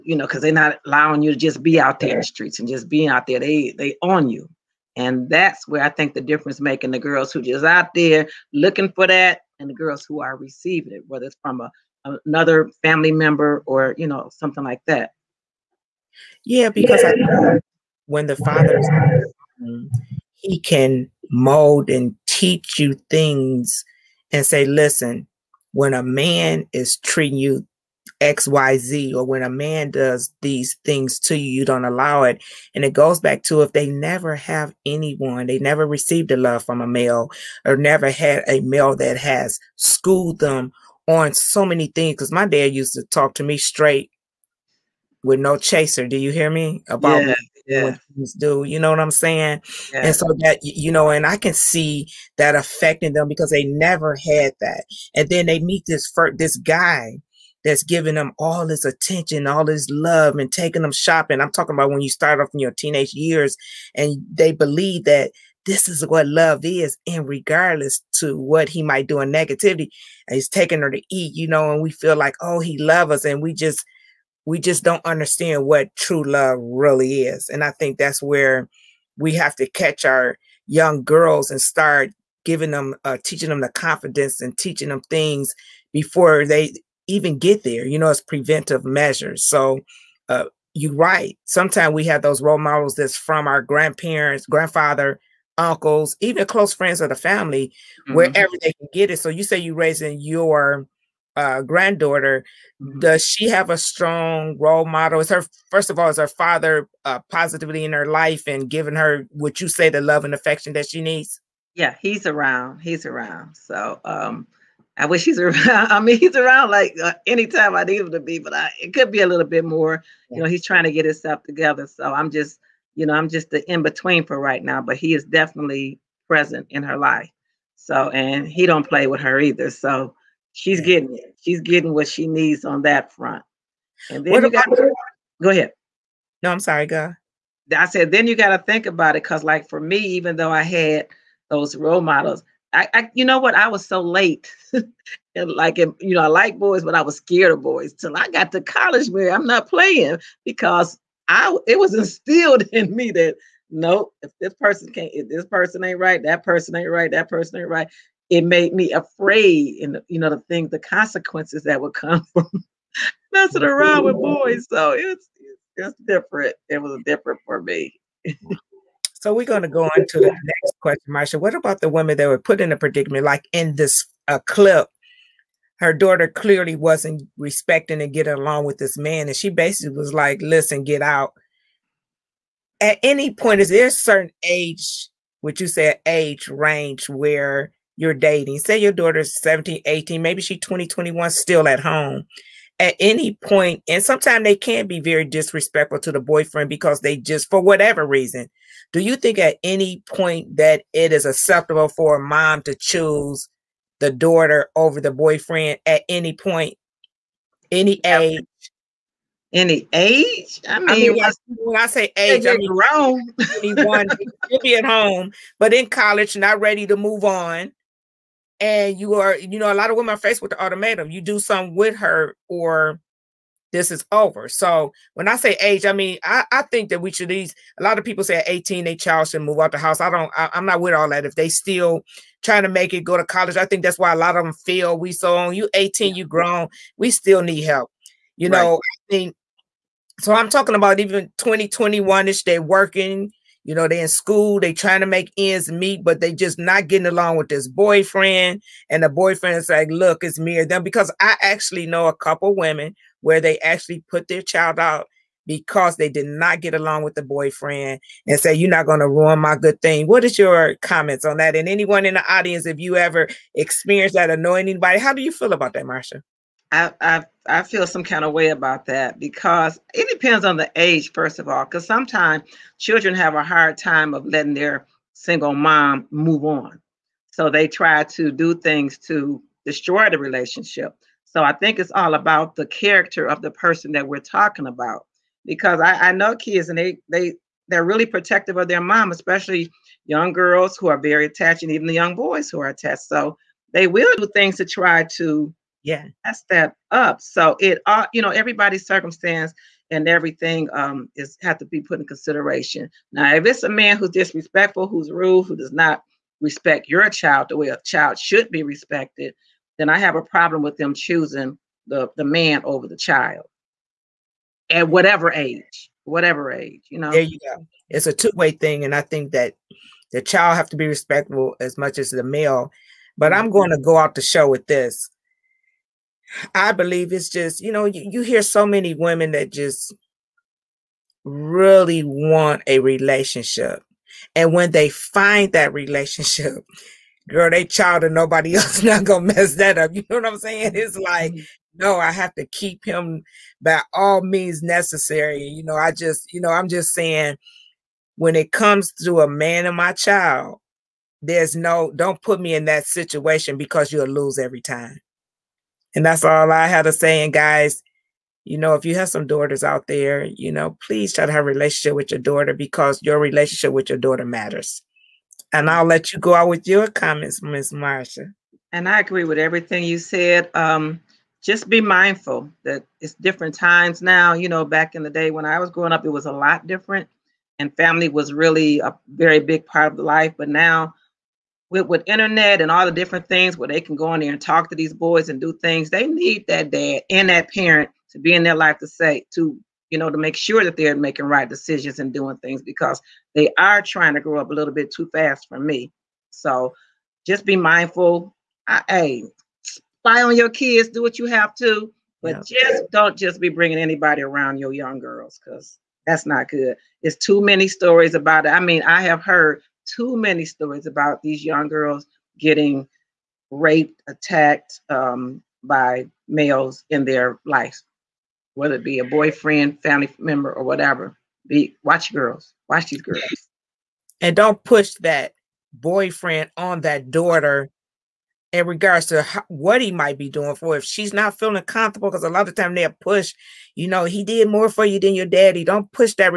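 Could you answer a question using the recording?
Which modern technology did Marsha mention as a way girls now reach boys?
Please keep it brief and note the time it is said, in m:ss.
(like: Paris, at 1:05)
Internet, at 6:22.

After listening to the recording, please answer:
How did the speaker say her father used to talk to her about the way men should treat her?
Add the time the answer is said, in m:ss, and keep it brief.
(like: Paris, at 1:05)
Straight with no chaser, at 0:43.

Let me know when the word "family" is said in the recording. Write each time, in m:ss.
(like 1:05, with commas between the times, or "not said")
0:12, 1:37, 6:17, 6:59.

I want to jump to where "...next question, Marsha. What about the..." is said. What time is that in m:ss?
2:50.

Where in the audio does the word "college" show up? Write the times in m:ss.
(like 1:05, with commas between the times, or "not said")
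2:28, 3:35, 3:53.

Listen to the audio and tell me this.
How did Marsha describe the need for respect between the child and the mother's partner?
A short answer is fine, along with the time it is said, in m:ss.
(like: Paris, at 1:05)
A two way thing, at 5:18.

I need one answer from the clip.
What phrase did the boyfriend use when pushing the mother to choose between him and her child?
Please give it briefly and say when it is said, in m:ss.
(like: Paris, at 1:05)
It's me or them, at 4:10.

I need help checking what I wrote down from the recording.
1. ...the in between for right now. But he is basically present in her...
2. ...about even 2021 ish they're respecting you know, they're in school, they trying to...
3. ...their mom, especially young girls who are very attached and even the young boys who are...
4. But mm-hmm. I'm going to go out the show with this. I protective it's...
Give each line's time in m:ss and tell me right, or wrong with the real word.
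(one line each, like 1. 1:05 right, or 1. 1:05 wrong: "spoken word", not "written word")
1. 2:03 wrong: "definitely", not "basically"
2. 4:00 wrong: "working", not "respecting"
3. 4:48 right
4. 5:23 wrong: "believe", not "protective".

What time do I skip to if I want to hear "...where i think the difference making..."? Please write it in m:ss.
0:05.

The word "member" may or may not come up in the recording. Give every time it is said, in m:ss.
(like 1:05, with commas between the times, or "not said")
0:13, 7:00.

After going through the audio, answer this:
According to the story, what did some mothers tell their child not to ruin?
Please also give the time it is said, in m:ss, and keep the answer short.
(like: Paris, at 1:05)
My good thing, at 4:19.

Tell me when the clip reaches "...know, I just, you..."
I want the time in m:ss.
5:45.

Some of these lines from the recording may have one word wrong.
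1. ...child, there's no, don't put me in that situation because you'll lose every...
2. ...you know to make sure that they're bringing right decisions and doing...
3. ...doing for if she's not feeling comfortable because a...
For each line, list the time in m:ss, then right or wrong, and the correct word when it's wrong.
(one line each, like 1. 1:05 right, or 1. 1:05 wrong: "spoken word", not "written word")
1. 5:49 right
2. 6:29 wrong: "making", not "bringing"
3. 7:10 right.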